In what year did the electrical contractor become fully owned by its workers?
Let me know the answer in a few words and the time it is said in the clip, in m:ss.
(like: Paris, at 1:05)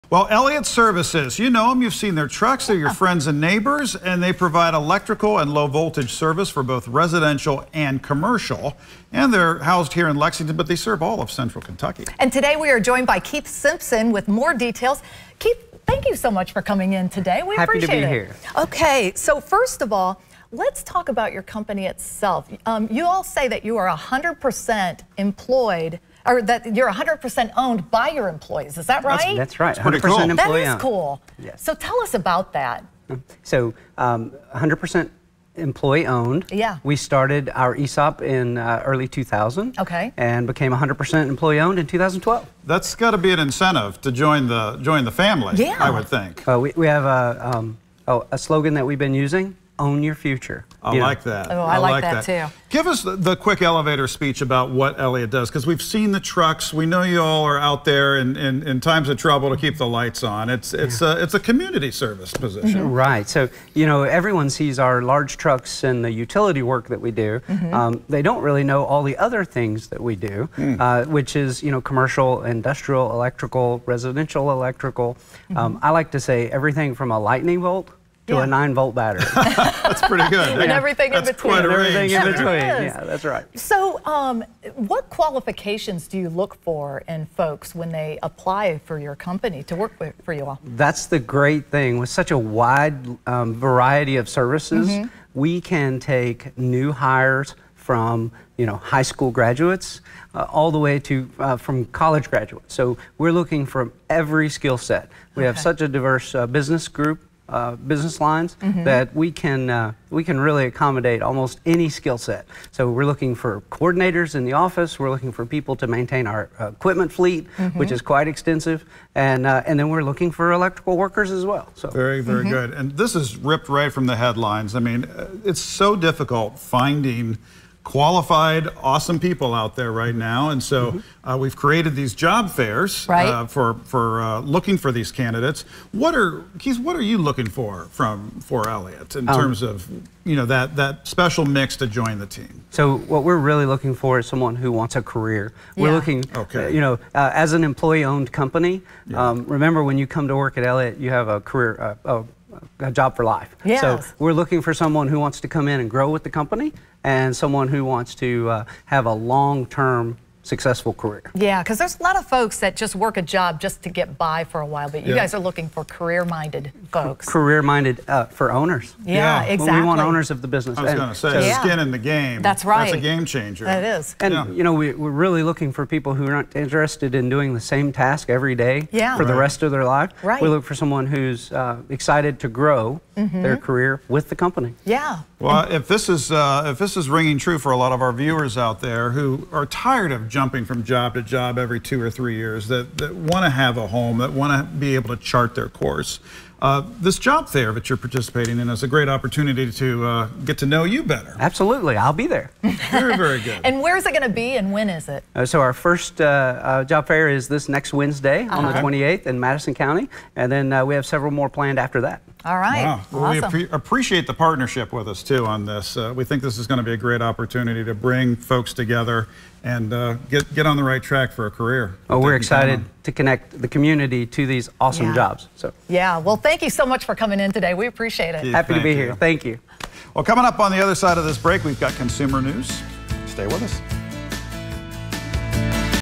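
2012, at 0:41.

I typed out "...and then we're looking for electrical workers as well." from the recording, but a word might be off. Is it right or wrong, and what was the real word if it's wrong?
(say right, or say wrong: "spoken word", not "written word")
right.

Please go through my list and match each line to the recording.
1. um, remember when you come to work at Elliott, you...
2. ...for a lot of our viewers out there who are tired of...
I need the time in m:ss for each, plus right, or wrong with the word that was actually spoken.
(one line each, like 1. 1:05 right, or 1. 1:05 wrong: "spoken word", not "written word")
1. 2:29 right
2. 3:07 right.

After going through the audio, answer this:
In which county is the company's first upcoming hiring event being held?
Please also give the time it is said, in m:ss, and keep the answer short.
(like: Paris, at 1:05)
Madison County, at 3:29.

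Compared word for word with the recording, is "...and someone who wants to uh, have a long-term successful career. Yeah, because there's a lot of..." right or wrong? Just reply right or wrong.
right.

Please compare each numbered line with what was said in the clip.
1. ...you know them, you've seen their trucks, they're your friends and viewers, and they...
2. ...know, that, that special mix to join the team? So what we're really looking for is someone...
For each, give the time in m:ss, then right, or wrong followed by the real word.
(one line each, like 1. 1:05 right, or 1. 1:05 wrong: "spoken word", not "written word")
1. 0:01 wrong: "neighbors", not "viewers"
2. 2:20 right.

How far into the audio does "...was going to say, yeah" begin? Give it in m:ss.
2:50.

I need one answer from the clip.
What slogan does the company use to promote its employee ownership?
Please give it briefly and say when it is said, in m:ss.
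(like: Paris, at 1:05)
Own your future, at 0:49.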